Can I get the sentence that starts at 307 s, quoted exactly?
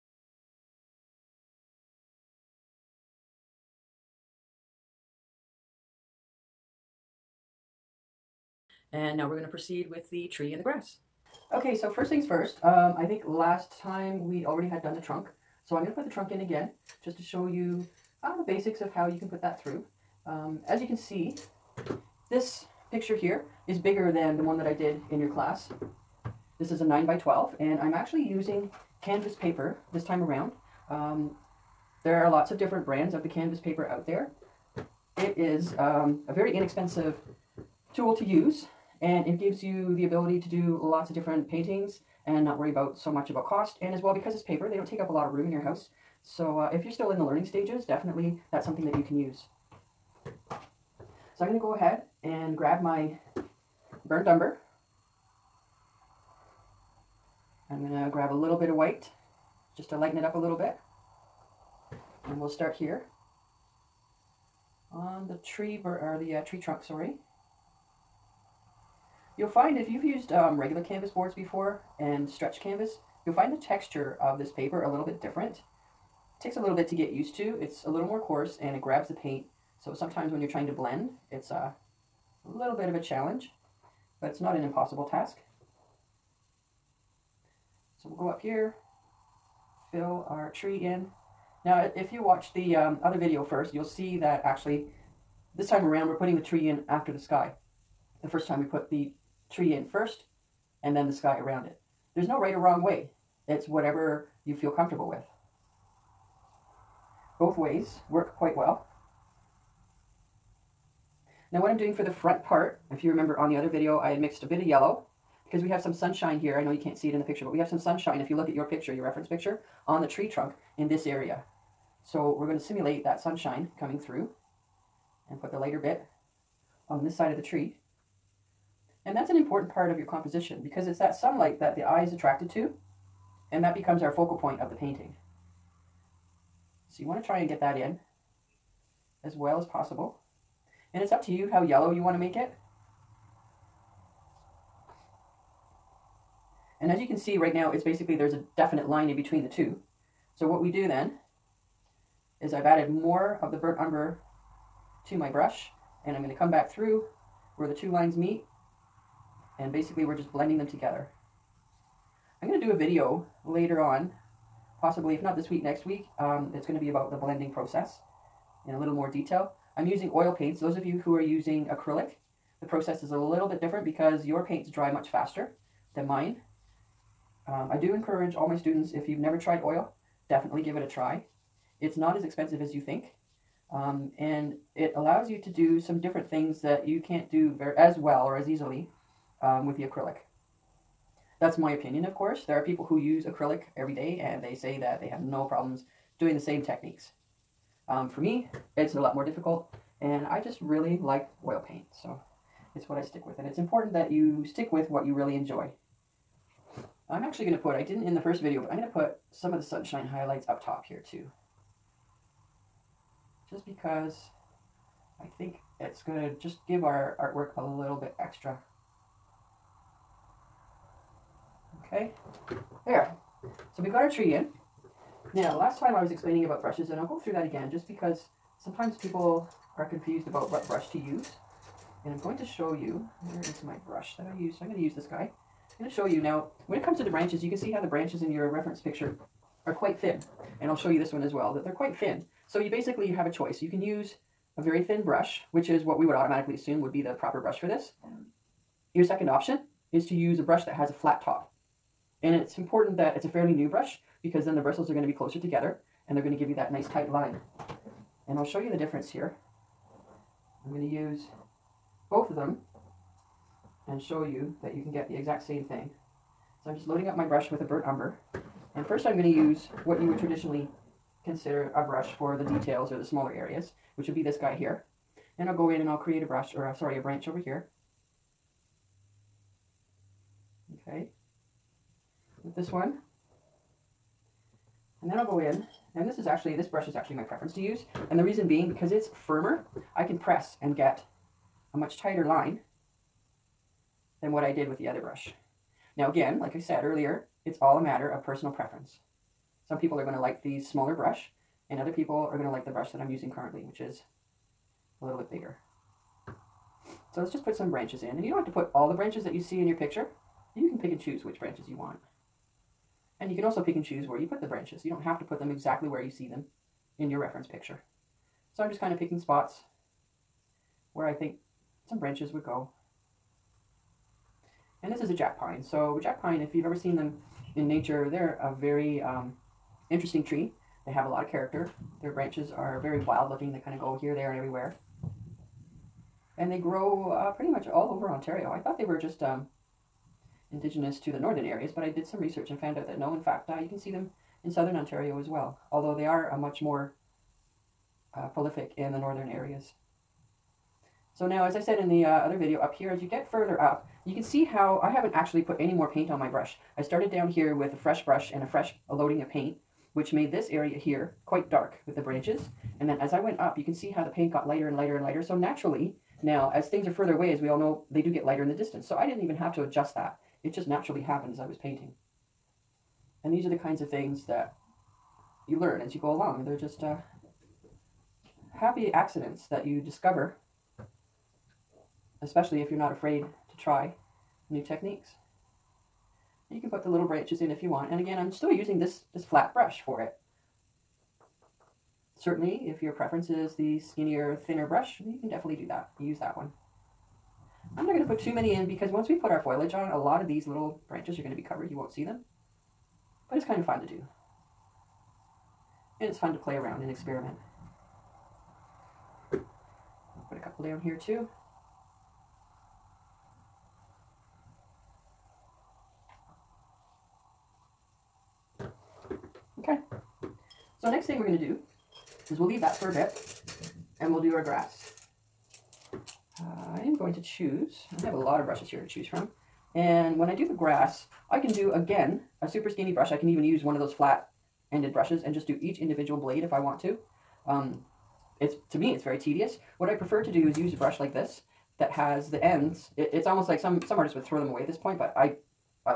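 So let's just put some branches in.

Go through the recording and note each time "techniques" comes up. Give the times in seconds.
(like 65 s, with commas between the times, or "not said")
196 s, 384 s.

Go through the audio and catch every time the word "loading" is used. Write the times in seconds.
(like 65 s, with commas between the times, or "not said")
266 s, 358 s.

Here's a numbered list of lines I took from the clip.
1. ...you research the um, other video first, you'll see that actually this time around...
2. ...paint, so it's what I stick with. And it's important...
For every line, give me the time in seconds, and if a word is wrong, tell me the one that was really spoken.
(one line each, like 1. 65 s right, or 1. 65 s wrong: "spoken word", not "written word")
1. 92 s wrong: "watch", not "research"
2. 201 s right.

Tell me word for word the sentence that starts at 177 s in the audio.
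Um, I do encourage all my students, if you've never tried oil, definitely give it a try.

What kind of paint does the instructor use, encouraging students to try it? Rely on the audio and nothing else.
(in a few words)
Oil paints.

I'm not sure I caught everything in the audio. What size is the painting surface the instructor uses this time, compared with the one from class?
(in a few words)
9 by 12.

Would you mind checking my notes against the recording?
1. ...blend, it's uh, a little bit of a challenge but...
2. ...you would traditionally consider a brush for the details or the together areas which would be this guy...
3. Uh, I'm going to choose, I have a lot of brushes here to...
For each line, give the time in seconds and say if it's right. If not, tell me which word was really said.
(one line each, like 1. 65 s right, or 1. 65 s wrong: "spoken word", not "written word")
1. 80 s right
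2. 269 s wrong: "smaller", not "together"
3. 425 s right.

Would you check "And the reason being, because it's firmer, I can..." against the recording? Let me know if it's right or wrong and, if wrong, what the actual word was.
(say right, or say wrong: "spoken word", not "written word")
right.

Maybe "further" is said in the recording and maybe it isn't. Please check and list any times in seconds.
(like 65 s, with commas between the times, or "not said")
353 s, 366 s.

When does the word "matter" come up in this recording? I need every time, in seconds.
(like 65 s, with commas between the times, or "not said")
297 s.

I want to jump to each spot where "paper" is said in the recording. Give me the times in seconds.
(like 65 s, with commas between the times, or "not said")
29 s, 33 s, 44 s, 74 s.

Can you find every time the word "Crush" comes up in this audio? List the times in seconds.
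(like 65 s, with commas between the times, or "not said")
not said.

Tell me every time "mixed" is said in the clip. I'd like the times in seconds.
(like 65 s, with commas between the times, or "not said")
114 s.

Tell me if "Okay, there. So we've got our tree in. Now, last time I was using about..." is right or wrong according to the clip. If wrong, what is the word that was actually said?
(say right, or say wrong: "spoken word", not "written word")
wrong: "explaining", not "using".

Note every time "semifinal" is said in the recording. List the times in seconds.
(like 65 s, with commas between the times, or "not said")
not said.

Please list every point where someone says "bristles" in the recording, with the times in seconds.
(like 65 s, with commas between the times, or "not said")
254 s.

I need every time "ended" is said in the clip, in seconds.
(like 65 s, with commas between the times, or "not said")
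434 s.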